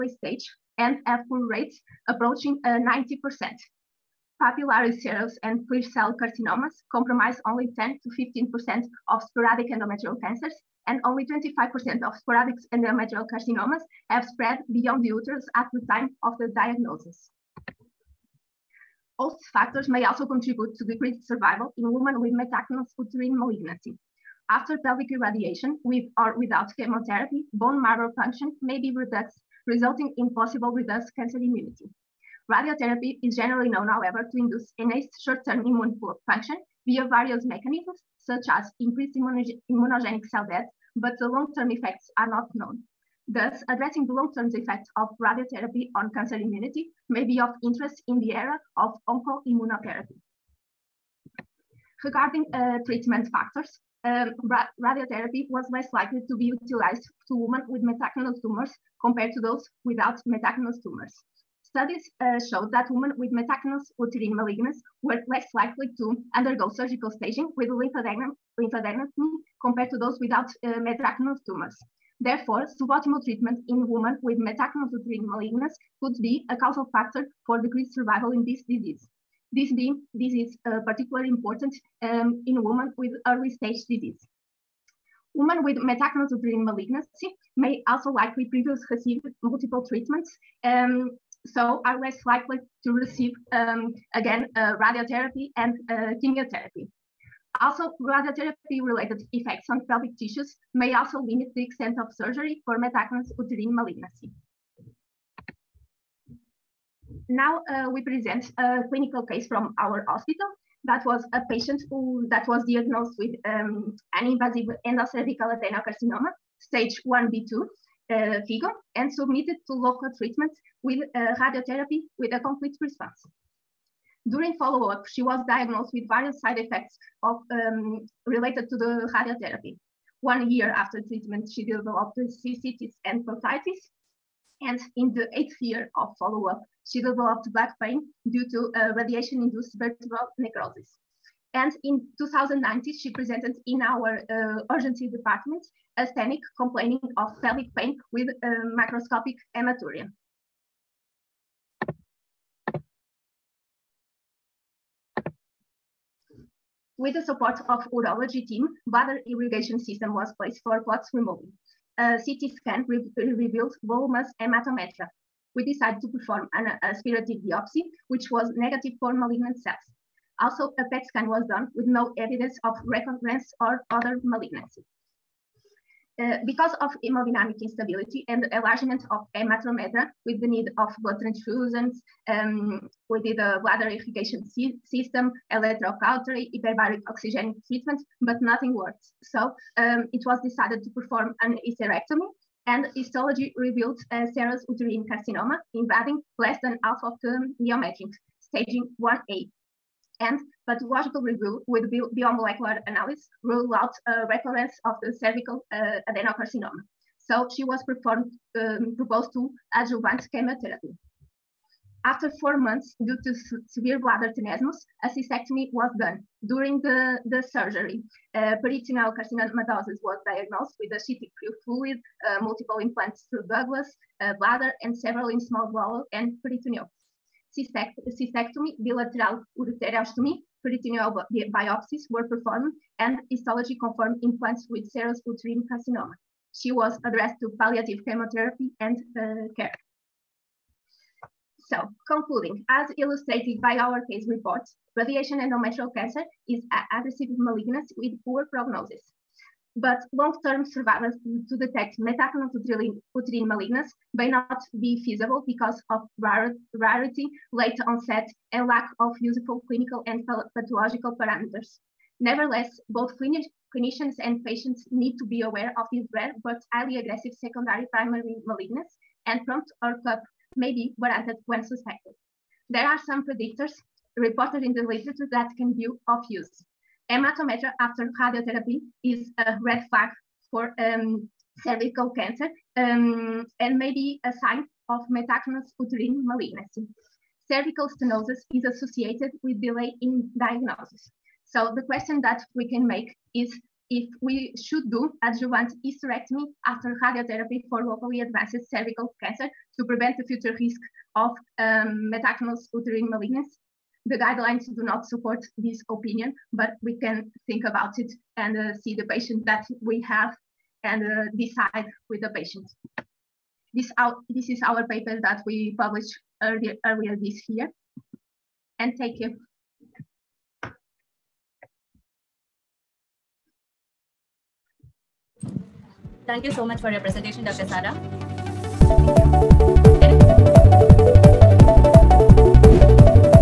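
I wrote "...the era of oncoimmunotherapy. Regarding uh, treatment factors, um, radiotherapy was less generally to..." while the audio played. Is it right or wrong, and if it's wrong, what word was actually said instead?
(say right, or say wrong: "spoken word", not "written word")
wrong: "likely", not "generally".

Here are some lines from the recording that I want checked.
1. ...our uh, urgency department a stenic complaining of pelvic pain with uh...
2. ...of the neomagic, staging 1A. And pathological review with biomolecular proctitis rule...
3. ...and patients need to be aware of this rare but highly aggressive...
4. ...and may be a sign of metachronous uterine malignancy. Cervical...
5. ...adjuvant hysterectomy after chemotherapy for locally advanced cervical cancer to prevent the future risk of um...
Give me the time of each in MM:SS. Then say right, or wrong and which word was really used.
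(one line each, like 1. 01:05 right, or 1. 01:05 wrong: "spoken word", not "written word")
1. 02:23 right
2. 03:17 wrong: "analysis", not "proctitis"
3. 04:24 right
4. 04:43 right
5. 04:55 wrong: "radiotherapy", not "chemotherapy".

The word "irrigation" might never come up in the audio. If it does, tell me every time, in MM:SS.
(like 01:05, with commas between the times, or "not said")
02:39, 03:03.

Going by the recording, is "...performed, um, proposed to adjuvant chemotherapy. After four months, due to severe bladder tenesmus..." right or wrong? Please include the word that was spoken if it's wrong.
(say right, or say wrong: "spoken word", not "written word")
right.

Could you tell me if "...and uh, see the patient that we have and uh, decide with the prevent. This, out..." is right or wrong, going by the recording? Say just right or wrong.
wrong.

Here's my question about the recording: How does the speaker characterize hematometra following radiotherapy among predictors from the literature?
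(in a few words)
A red flag.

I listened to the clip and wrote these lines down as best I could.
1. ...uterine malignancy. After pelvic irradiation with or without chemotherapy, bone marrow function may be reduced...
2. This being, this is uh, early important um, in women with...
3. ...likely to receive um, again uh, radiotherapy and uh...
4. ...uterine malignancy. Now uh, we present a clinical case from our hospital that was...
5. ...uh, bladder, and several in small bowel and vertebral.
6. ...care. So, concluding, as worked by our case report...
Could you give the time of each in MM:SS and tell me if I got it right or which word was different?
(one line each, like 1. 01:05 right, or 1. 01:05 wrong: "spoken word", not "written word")
1. 00:22 right
2. 01:19 wrong: "particularly", not "early"
3. 01:32 right
4. 01:43 right
5. 03:44 wrong: "peritoneal", not "vertebral"
6. 03:59 wrong: "illustrated", not "worked".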